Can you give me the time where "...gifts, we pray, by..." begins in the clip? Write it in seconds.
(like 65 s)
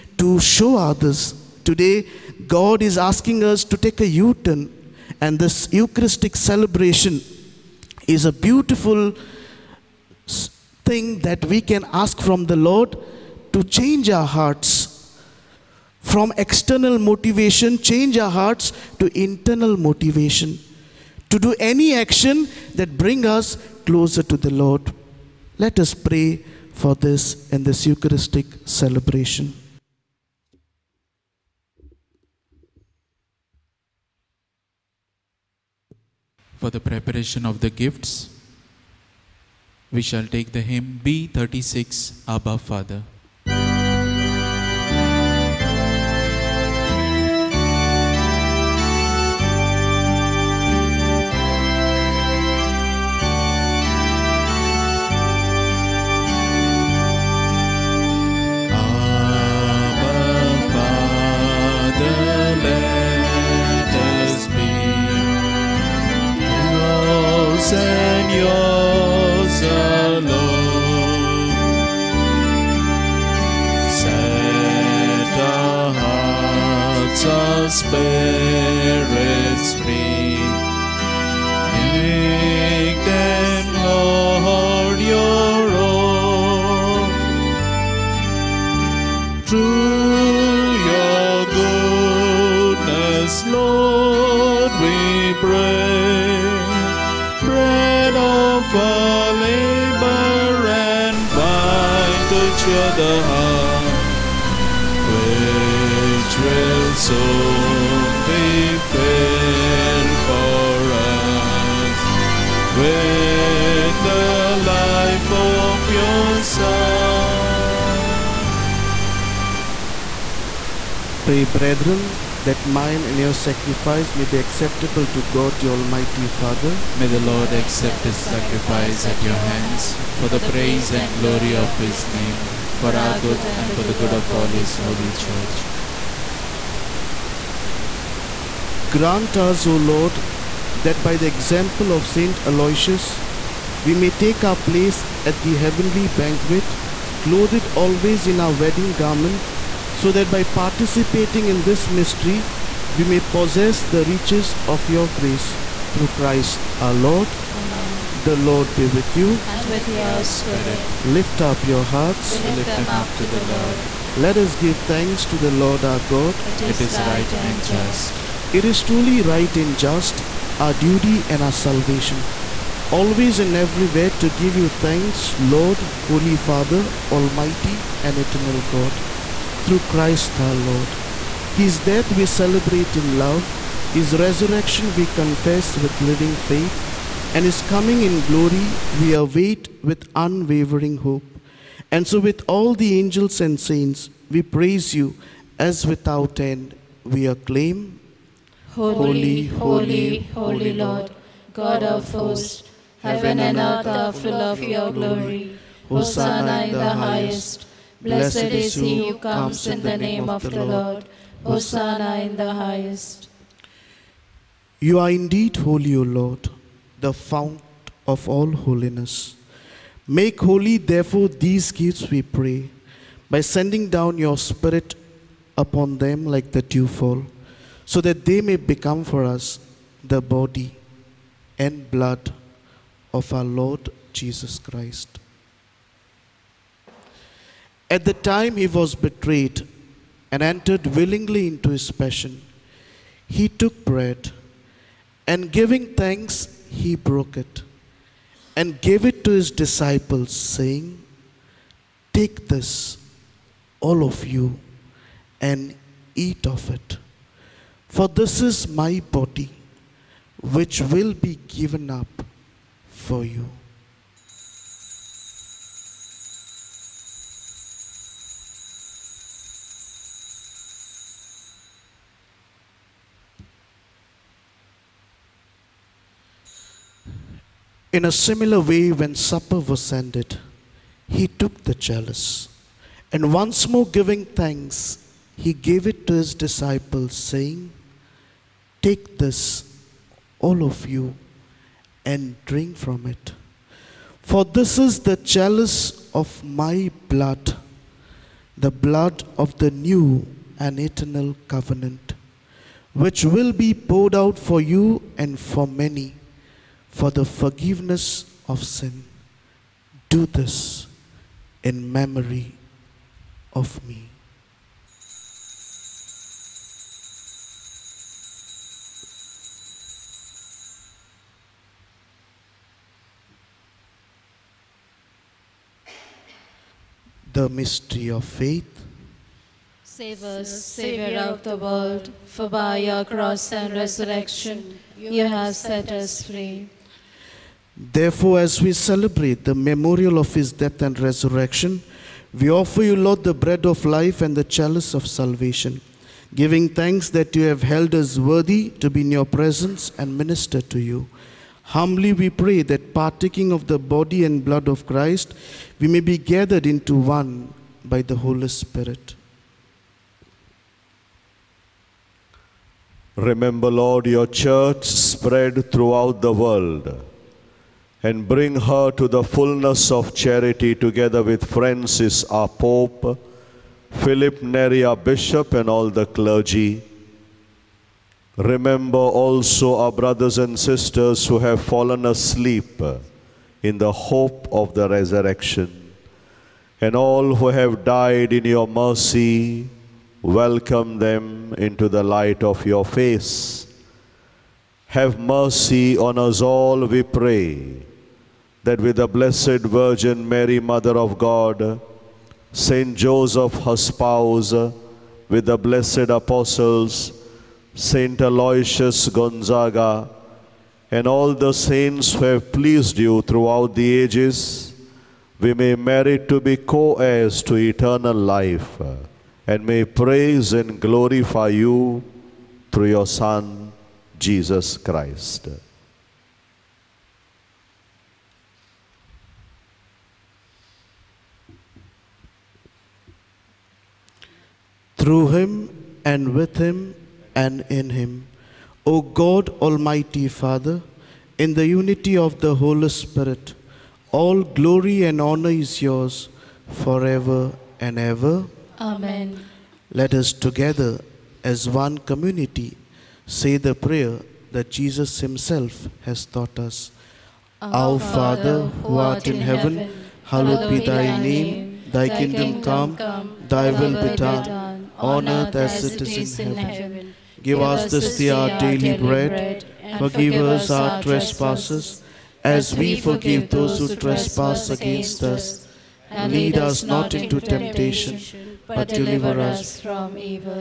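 221 s.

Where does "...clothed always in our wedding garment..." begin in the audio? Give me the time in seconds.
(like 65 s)
147 s.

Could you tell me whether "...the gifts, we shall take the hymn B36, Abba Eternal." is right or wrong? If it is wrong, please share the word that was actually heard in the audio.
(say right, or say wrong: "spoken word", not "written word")
wrong: "Father", not "Eternal".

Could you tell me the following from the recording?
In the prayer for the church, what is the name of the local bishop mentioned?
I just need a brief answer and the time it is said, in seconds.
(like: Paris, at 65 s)
Philip Neri, at 373 s.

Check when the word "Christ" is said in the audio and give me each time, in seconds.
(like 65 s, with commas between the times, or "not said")
156 s, 179 s, 234 s, 354 s, 424 s.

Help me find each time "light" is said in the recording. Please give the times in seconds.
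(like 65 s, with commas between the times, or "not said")
392 s.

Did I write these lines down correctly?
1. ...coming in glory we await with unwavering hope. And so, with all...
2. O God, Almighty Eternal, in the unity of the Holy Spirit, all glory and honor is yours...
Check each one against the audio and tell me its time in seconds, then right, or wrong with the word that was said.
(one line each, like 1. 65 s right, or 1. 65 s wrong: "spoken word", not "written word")
1. 187 s right
2. 438 s wrong: "Father", not "Eternal".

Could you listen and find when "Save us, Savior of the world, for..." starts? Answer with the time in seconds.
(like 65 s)
329 s.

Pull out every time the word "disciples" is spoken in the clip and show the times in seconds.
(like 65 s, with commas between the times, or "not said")
249 s, 286 s.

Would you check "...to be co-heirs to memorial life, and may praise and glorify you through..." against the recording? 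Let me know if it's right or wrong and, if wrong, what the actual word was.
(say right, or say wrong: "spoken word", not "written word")
wrong: "eternal", not "memorial".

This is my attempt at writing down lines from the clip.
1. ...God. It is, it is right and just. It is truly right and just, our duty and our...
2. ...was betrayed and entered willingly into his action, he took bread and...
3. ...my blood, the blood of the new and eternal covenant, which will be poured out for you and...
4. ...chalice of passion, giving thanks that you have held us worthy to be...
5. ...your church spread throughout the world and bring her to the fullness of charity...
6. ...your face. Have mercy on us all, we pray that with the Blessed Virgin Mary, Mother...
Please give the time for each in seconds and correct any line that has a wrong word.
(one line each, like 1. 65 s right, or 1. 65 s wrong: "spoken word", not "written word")
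1. 165 s right
2. 238 s wrong: "passion", not "action"
3. 296 s right
4. 344 s wrong: "salvation", not "passion"
5. 364 s right
6. 392 s right.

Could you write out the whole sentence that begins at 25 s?
Let us pray for this in this Eucharistic celebration.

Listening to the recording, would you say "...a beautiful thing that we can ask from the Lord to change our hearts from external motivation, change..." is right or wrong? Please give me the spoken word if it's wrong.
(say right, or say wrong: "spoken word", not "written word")
right.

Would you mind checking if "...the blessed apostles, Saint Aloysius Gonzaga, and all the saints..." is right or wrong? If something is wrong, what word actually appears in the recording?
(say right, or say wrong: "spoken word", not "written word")
right.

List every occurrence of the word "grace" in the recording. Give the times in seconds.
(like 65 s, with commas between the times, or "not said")
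155 s.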